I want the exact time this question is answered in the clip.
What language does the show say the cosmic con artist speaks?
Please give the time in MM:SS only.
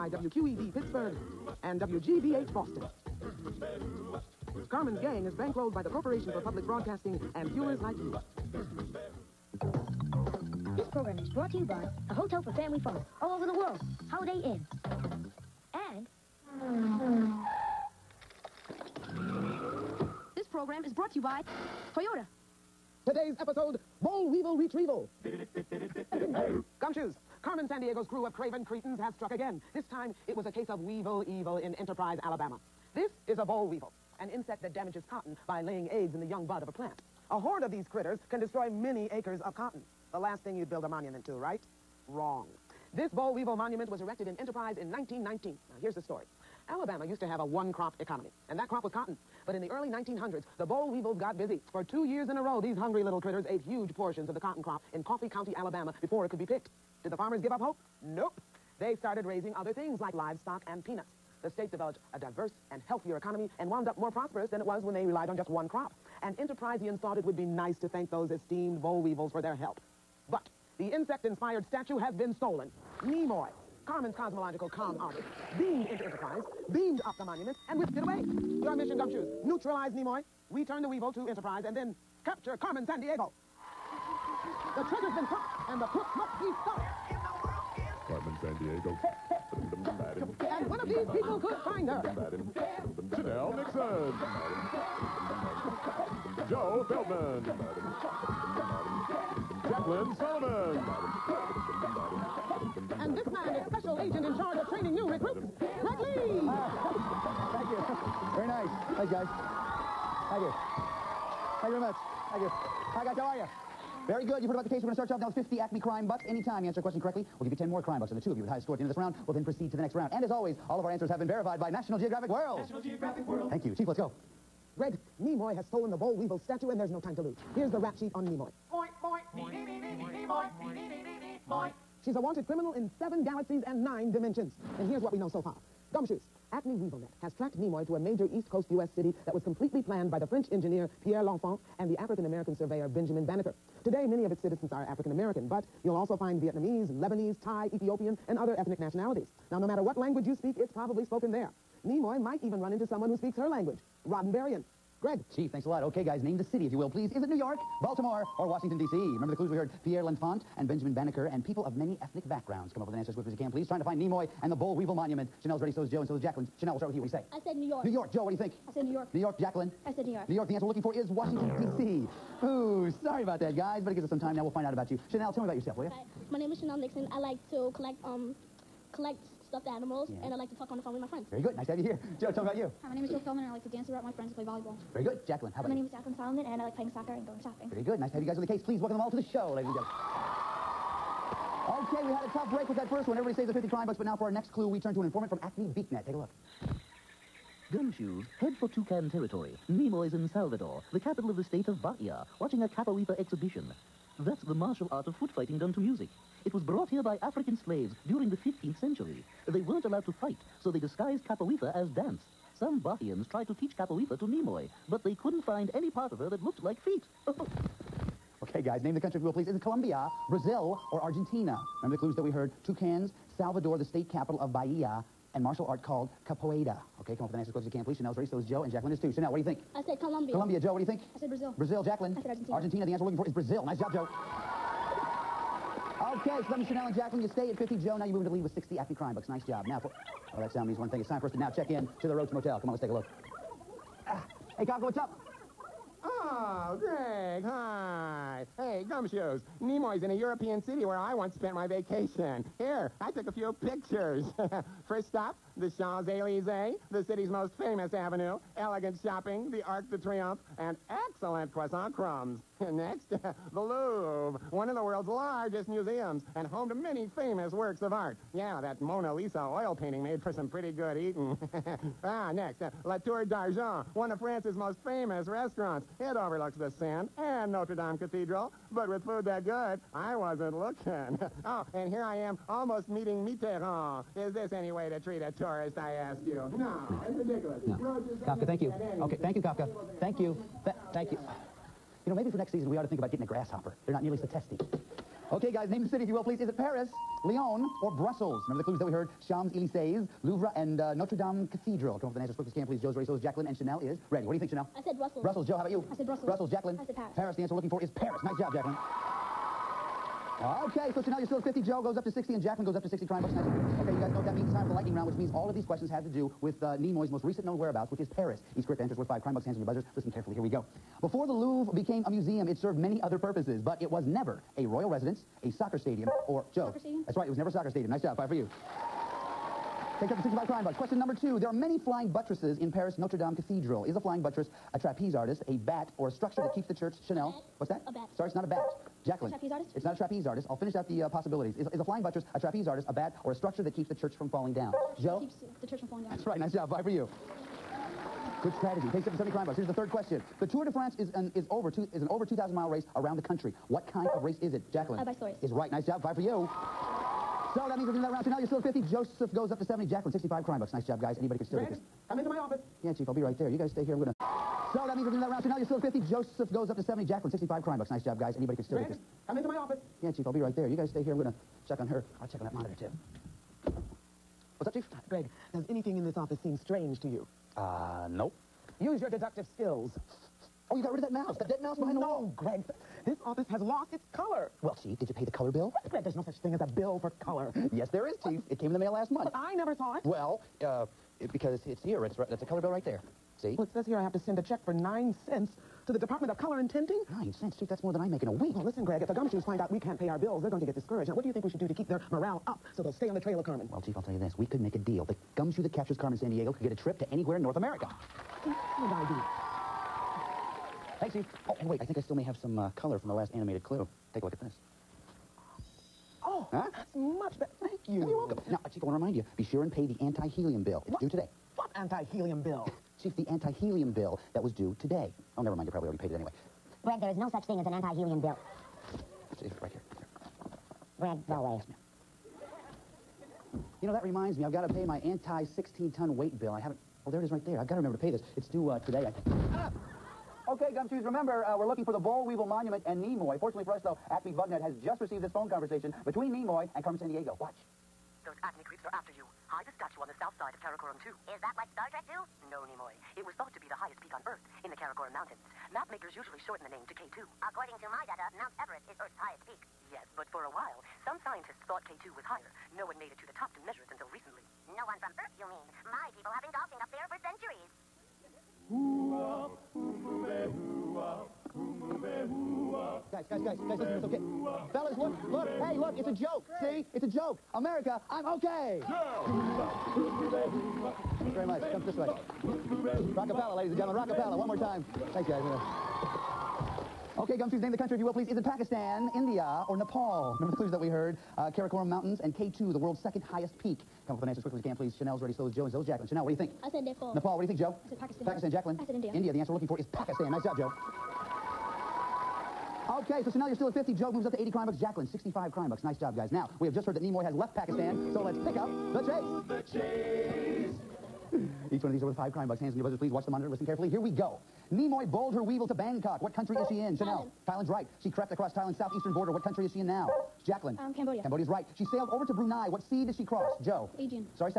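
02:34.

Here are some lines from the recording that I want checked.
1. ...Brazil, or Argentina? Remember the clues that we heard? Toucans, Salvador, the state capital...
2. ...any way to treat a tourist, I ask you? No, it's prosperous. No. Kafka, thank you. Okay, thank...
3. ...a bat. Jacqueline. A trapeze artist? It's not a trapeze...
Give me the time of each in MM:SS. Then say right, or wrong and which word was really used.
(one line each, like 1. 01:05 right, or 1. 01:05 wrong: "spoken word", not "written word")
1. 03:40 right
2. 04:44 wrong: "ridiculous", not "prosperous"
3. 05:38 right.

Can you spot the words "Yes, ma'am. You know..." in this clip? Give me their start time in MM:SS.
07:11.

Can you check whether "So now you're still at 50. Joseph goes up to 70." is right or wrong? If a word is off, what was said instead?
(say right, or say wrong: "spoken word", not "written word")
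right.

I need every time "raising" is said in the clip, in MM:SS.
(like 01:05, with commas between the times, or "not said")
00:59.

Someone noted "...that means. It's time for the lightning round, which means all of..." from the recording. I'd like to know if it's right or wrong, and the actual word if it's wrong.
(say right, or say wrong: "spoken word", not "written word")
right.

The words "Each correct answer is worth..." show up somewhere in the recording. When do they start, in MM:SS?
05:18.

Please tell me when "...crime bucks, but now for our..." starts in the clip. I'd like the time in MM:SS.
03:13.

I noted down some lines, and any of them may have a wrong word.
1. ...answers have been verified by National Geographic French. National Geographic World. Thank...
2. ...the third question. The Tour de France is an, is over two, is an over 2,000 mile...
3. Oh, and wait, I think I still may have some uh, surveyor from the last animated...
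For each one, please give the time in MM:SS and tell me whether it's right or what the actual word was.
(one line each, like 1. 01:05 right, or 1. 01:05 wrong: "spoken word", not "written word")
1. 02:00 wrong: "World", not "French"
2. 05:49 right
3. 06:51 wrong: "color", not "surveyor".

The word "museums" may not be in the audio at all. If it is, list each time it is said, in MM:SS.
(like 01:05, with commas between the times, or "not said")
04:25, 05:22.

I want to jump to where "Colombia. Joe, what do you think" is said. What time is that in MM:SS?
03:50.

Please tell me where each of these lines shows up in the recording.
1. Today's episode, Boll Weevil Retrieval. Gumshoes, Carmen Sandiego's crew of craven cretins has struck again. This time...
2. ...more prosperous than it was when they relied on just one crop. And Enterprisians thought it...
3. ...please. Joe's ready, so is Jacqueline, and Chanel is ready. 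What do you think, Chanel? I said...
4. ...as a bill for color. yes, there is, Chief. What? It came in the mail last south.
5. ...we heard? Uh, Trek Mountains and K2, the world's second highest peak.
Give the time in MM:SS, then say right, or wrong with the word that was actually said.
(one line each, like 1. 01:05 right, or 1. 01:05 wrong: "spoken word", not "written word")
1. 00:23 right
2. 01:03 right
3. 05:02 right
4. 06:26 wrong: "month", not "south"
5. 08:10 wrong: "Karakoram", not "Trek".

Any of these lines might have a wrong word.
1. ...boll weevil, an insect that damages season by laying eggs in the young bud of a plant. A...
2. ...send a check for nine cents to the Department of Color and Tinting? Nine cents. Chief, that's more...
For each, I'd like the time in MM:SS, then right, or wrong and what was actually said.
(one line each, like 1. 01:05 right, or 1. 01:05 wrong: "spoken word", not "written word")
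1. 00:33 wrong: "cotton", not "season"
2. 06:34 right.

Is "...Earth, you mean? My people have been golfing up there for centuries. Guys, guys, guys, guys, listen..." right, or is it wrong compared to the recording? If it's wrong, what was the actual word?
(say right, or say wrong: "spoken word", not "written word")
right.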